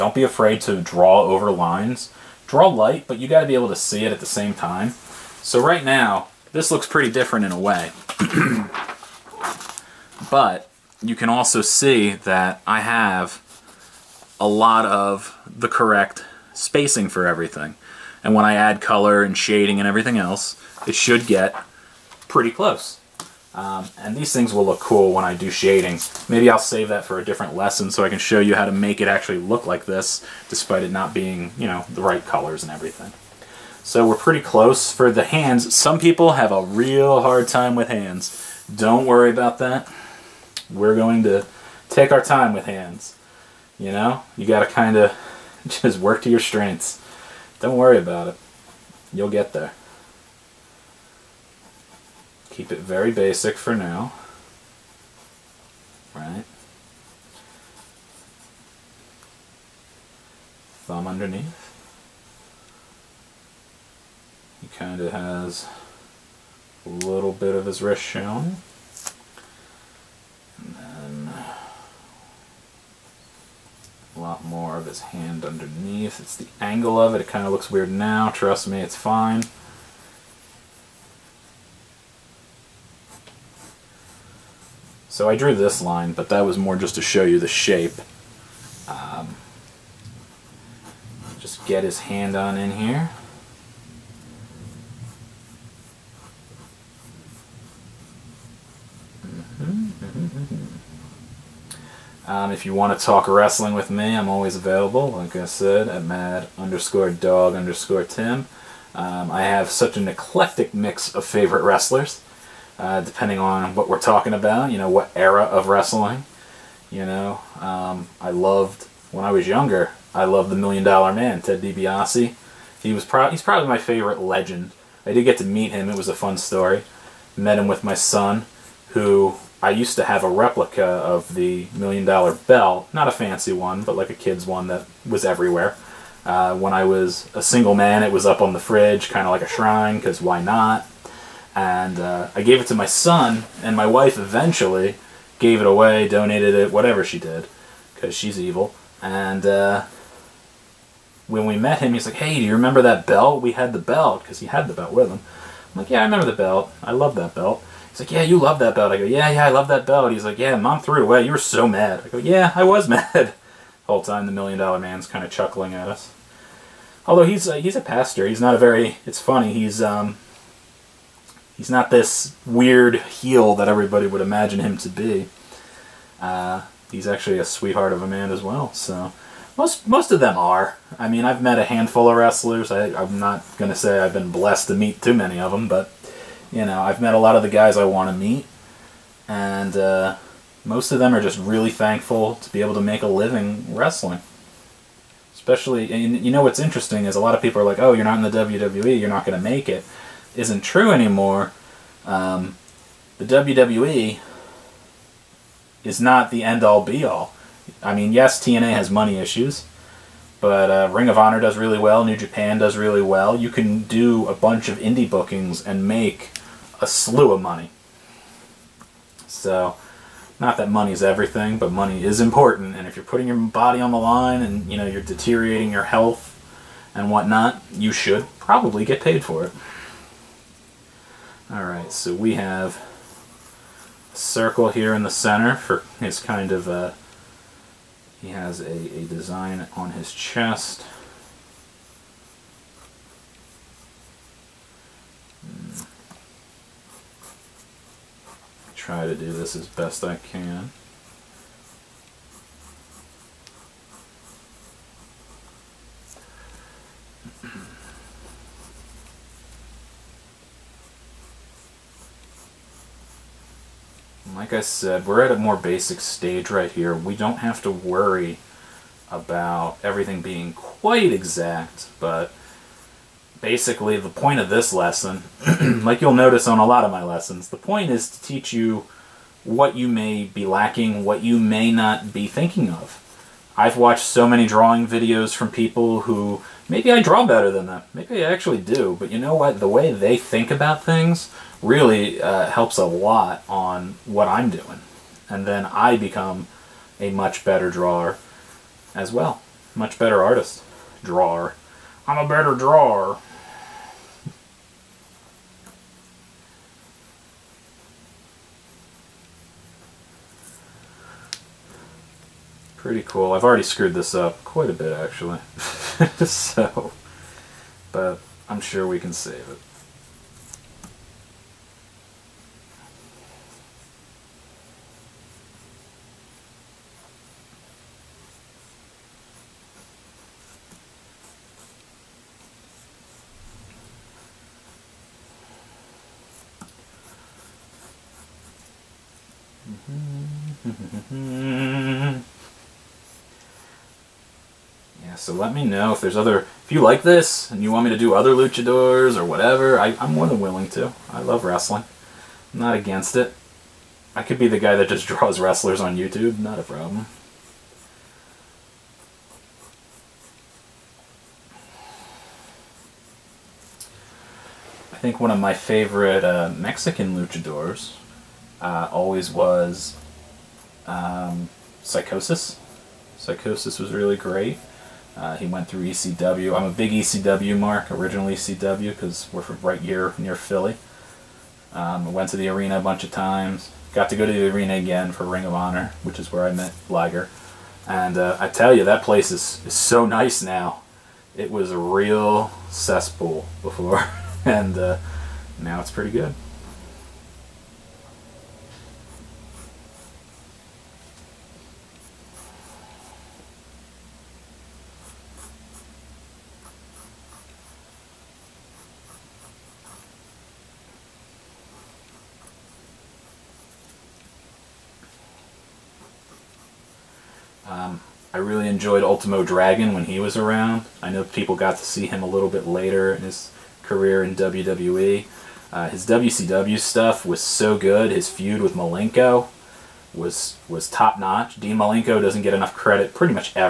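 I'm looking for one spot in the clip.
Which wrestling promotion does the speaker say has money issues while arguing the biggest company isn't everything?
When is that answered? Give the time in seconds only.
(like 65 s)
208 s.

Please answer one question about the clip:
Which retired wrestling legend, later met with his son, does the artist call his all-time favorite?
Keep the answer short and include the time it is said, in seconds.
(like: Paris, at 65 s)
Ted DiBiase, at 121 s.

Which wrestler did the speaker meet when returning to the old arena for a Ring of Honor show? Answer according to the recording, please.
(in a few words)
Liger.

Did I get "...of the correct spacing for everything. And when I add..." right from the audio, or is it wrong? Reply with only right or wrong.
right.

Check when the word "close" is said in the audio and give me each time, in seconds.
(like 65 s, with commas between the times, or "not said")
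22 s, 34 s.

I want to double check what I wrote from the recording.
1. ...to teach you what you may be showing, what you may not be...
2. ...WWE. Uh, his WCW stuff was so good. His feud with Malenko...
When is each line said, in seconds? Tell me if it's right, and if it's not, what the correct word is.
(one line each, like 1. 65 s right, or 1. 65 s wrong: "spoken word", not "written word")
1. 278 s wrong: "lacking", not "showing"
2. 424 s right.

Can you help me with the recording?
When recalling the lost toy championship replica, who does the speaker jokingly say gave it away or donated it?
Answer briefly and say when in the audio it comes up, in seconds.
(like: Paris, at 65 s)
my wife, at 143 s.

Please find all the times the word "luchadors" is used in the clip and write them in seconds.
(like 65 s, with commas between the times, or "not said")
348 s, 367 s.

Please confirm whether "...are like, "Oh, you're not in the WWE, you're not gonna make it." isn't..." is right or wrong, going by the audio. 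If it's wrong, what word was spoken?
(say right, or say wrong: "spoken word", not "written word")
right.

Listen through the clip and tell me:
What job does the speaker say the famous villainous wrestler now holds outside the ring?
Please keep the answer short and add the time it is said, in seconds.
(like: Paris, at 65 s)
pastor, at 167 s.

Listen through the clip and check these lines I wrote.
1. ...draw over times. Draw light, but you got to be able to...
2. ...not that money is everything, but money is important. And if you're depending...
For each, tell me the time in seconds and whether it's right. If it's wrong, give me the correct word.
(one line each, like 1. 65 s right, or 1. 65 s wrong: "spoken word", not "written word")
1. 0 s wrong: "lines", not "times"
2. 220 s wrong: "putting", not "depending".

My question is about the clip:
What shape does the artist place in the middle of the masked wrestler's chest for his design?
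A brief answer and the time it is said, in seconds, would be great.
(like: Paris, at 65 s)
circle, at 234 s.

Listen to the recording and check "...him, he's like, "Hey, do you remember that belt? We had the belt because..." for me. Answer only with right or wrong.
right.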